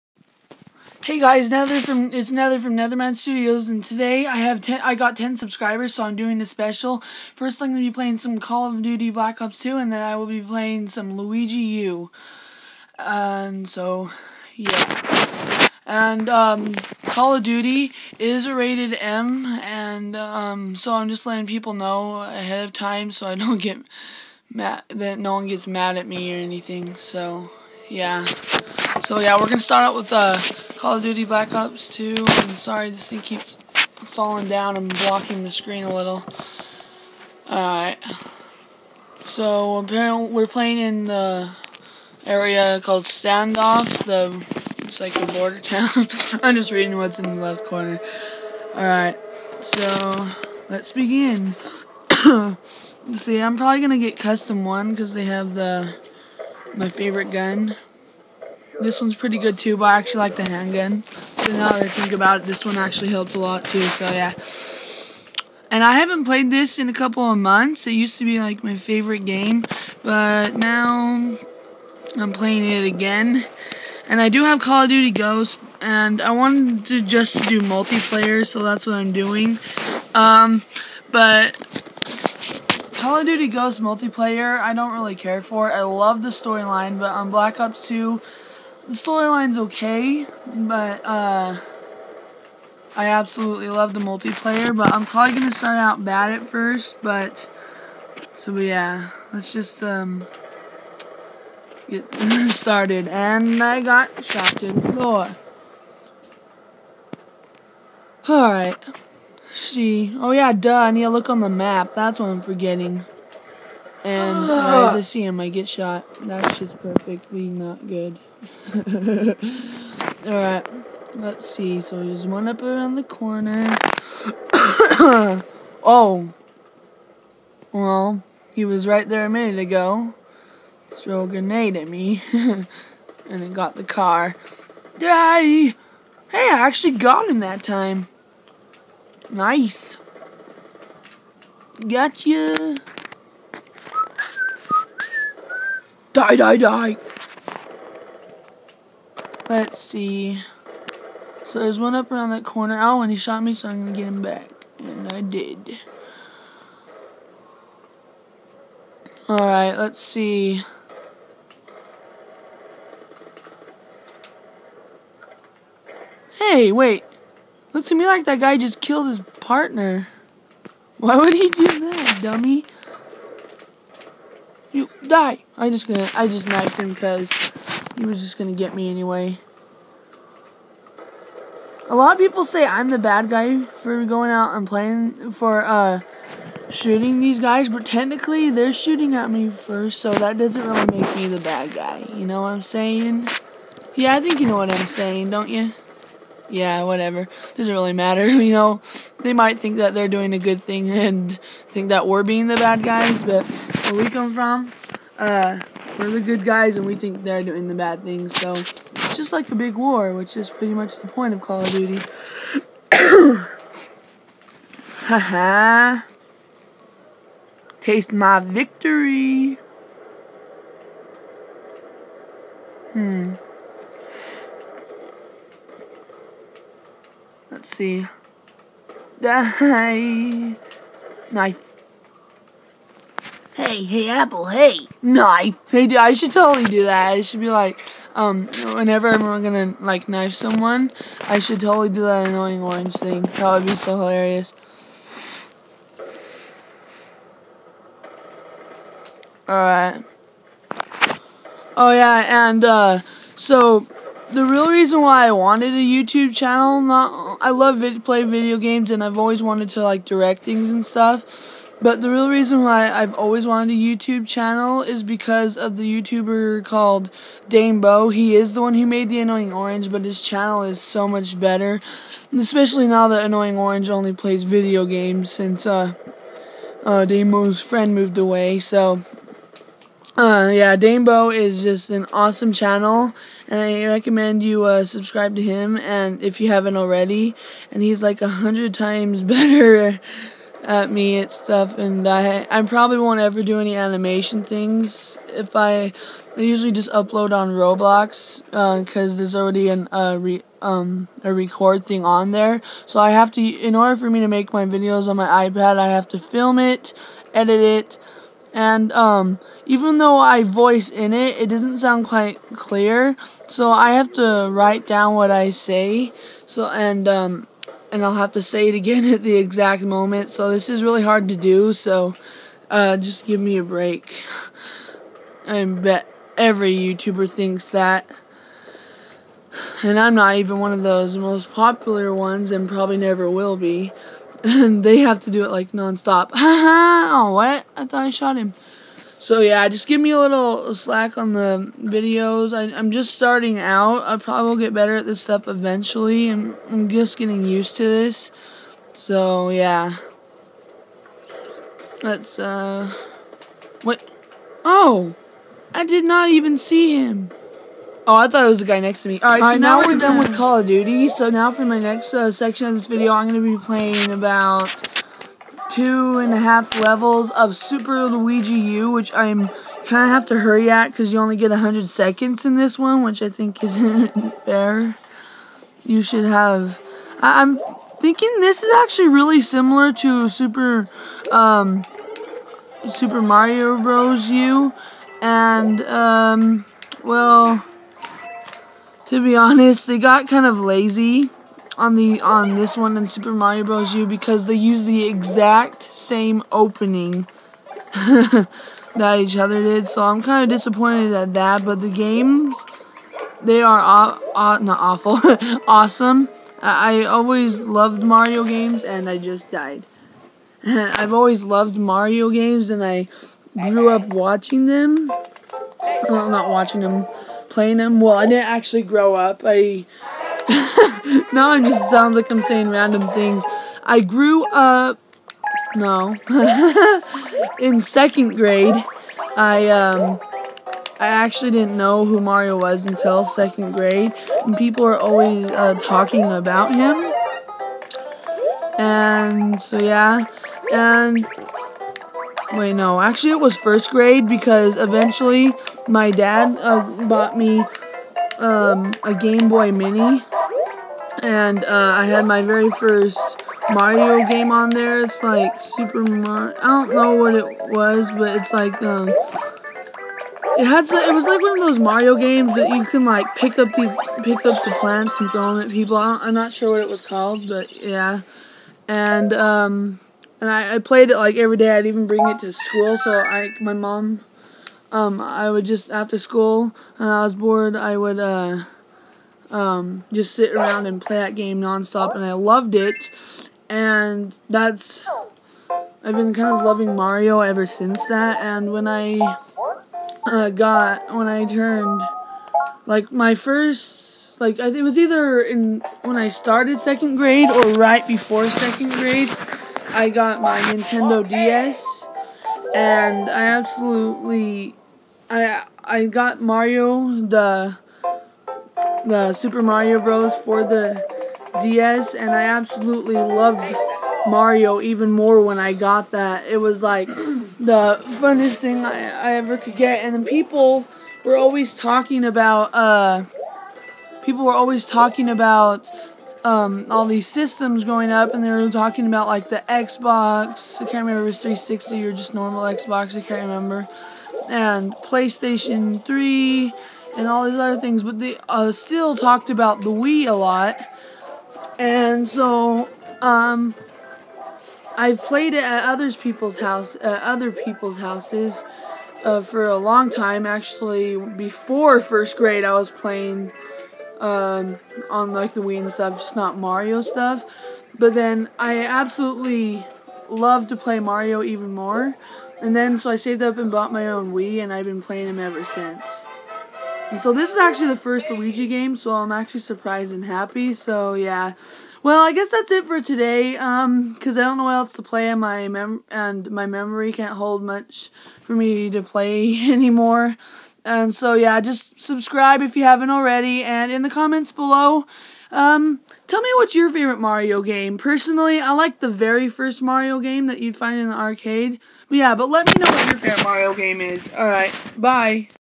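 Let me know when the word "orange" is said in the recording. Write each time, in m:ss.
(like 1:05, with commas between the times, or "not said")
4:02, 4:29, 4:33.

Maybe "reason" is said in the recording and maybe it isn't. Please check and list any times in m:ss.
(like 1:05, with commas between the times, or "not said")
4:14, 4:22.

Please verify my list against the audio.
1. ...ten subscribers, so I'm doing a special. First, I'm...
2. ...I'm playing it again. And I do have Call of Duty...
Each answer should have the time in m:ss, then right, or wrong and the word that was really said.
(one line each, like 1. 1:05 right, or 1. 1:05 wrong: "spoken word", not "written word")
1. 0:05 right
2. 1:12 right.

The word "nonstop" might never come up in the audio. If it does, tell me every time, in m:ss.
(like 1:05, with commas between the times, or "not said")
5:35, 8:01.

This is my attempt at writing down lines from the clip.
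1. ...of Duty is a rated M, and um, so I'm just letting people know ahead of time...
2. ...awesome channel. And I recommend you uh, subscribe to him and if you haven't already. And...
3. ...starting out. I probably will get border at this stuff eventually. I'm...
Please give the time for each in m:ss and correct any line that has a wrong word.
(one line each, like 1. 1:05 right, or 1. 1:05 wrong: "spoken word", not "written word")
1. 0:17 right
2. 4:42 right
3. 5:43 wrong: "better", not "border".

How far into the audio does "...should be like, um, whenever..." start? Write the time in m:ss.
3:57.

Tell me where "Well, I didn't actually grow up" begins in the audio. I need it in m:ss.
6:58.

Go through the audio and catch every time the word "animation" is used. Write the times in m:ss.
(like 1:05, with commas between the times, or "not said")
4:53.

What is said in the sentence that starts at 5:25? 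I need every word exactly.
I bet every YouTuber thinks that.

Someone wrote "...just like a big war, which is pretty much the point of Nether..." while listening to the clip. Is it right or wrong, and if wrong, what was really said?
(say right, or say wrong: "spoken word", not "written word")
wrong: "Call", not "Nether".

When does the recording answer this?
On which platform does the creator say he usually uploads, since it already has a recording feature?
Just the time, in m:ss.
4:57.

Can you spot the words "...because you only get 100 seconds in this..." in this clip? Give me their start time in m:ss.
6:10.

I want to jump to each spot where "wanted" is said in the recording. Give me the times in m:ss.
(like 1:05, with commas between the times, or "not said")
1:16, 4:15, 4:19, 4:23.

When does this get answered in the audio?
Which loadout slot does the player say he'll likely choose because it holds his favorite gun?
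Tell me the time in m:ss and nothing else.
0:54.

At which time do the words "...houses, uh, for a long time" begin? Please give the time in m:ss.
9:07.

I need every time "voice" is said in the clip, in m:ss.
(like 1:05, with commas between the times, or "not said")
5:10.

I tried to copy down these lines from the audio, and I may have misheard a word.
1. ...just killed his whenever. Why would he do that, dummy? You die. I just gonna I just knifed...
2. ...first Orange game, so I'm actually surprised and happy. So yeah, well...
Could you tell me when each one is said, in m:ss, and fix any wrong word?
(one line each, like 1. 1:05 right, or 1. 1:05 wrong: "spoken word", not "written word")
1. 2:48 wrong: "partner", not "whenever"
2. 9:27 wrong: "Luigi", not "Orange".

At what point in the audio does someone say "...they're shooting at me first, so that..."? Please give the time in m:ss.
3:08.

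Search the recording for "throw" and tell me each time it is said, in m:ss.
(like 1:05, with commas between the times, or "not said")
2:10, 7:45.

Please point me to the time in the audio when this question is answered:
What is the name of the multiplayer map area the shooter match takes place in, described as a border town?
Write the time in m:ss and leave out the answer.
0:43.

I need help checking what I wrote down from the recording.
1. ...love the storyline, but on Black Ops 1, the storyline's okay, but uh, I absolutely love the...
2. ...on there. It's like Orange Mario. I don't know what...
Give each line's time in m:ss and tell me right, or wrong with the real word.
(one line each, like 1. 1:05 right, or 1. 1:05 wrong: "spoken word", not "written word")
1. 1:25 wrong: "2", not "1"
2. 7:34 wrong: "Super", not "Orange".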